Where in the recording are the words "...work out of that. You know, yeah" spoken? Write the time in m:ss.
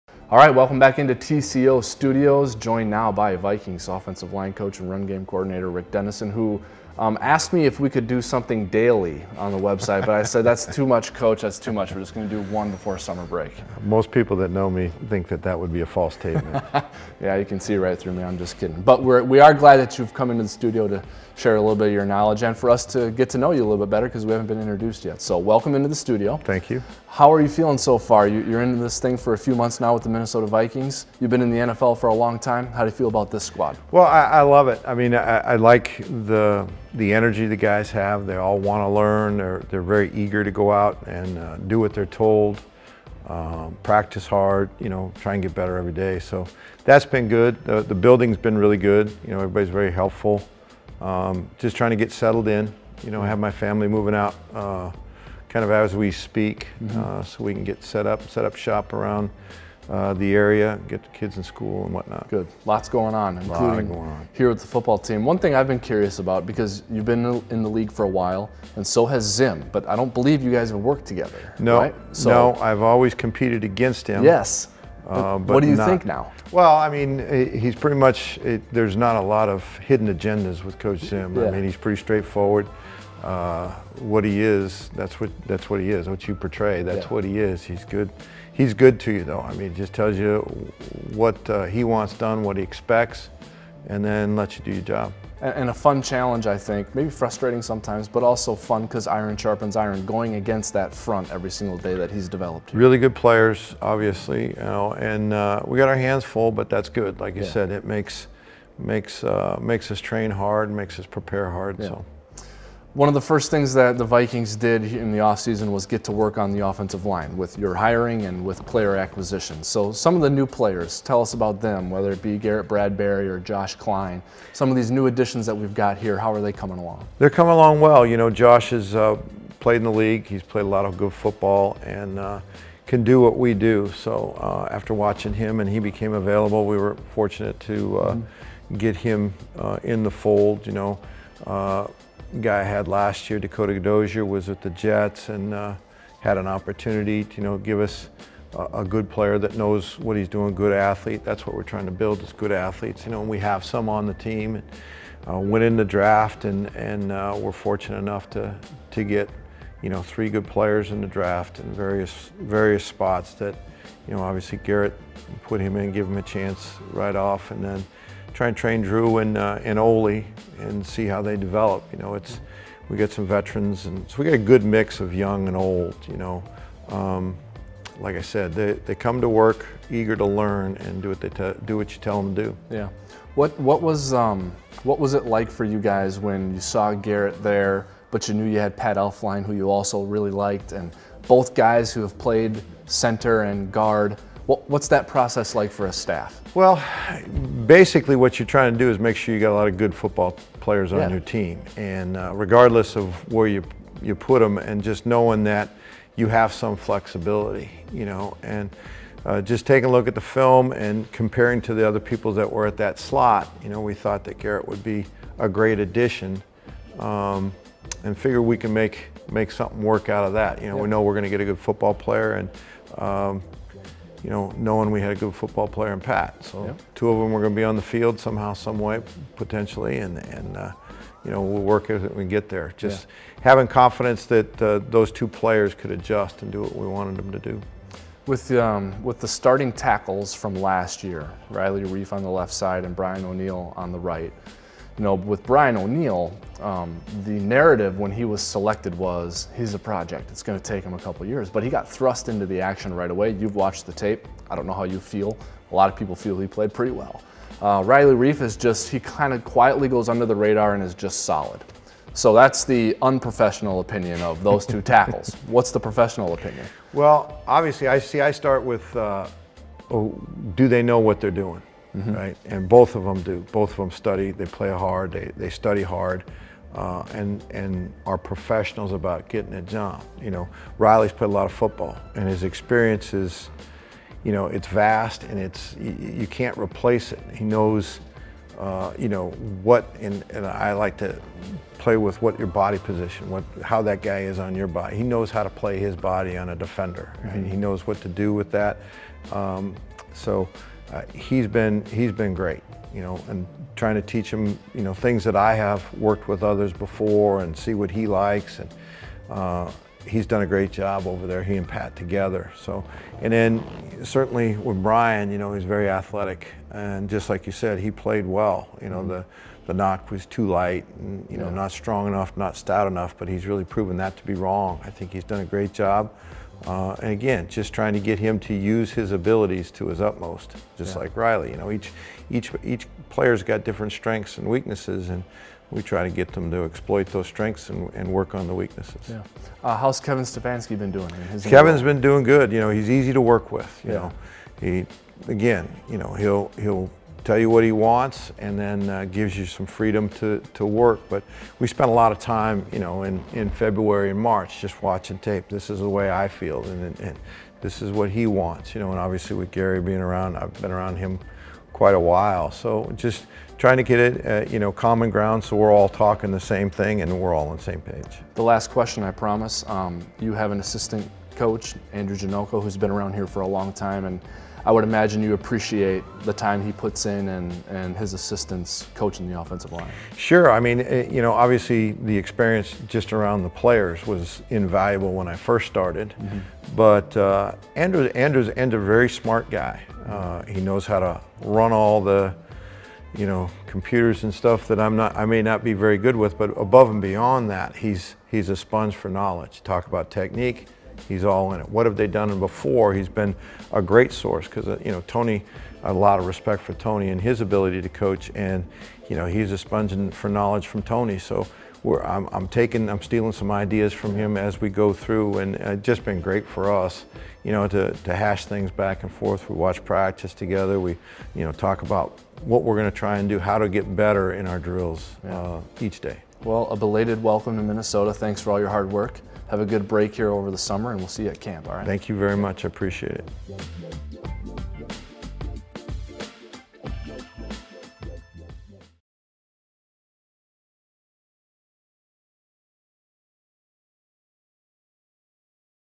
3:39.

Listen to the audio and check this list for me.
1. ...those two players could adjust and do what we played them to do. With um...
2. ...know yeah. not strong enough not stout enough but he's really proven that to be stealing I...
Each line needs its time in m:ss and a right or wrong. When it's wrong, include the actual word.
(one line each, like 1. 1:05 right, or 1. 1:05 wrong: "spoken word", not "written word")
1. 3:54 wrong: "wanted", not "played"
2. 5:21 wrong: "wrong", not "stealing".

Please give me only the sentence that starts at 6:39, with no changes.
Talk about technique, he's all in it.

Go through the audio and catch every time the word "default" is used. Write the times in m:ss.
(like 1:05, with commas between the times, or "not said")
not said.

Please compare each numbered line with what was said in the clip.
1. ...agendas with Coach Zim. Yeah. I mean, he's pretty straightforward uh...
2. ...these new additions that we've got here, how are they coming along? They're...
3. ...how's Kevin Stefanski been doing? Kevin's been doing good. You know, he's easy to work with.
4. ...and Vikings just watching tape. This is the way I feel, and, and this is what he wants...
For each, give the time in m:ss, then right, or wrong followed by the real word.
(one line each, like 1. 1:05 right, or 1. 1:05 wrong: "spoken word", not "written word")
1. 1:20 right
2. 2:04 right
3. 5:39 right
4. 5:54 wrong: "March", not "Vikings".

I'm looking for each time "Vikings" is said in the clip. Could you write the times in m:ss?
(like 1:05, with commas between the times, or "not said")
0:03, 0:30, 1:54.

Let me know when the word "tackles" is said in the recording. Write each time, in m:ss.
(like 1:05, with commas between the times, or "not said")
3:59, 4:24.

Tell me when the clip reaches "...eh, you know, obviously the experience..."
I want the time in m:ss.
6:21.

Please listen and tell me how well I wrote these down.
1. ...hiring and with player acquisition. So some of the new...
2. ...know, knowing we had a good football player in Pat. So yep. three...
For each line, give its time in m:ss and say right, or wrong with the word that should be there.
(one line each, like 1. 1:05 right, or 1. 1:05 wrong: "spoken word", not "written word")
1. 1:57 right
2. 3:44 wrong: "two", not "three".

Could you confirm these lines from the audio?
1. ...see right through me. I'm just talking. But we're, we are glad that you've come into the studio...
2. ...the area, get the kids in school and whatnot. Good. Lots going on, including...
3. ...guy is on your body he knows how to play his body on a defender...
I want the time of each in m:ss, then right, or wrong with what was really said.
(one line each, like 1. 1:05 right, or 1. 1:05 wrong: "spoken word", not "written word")
1. 0:17 wrong: "kidding", not "talking"
2. 1:00 right
3. 4:54 right.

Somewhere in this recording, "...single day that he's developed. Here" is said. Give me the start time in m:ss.
1:41.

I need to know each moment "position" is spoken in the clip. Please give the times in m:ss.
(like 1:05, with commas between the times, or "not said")
4:52.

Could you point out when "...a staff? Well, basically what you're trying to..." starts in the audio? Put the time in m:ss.
3:15.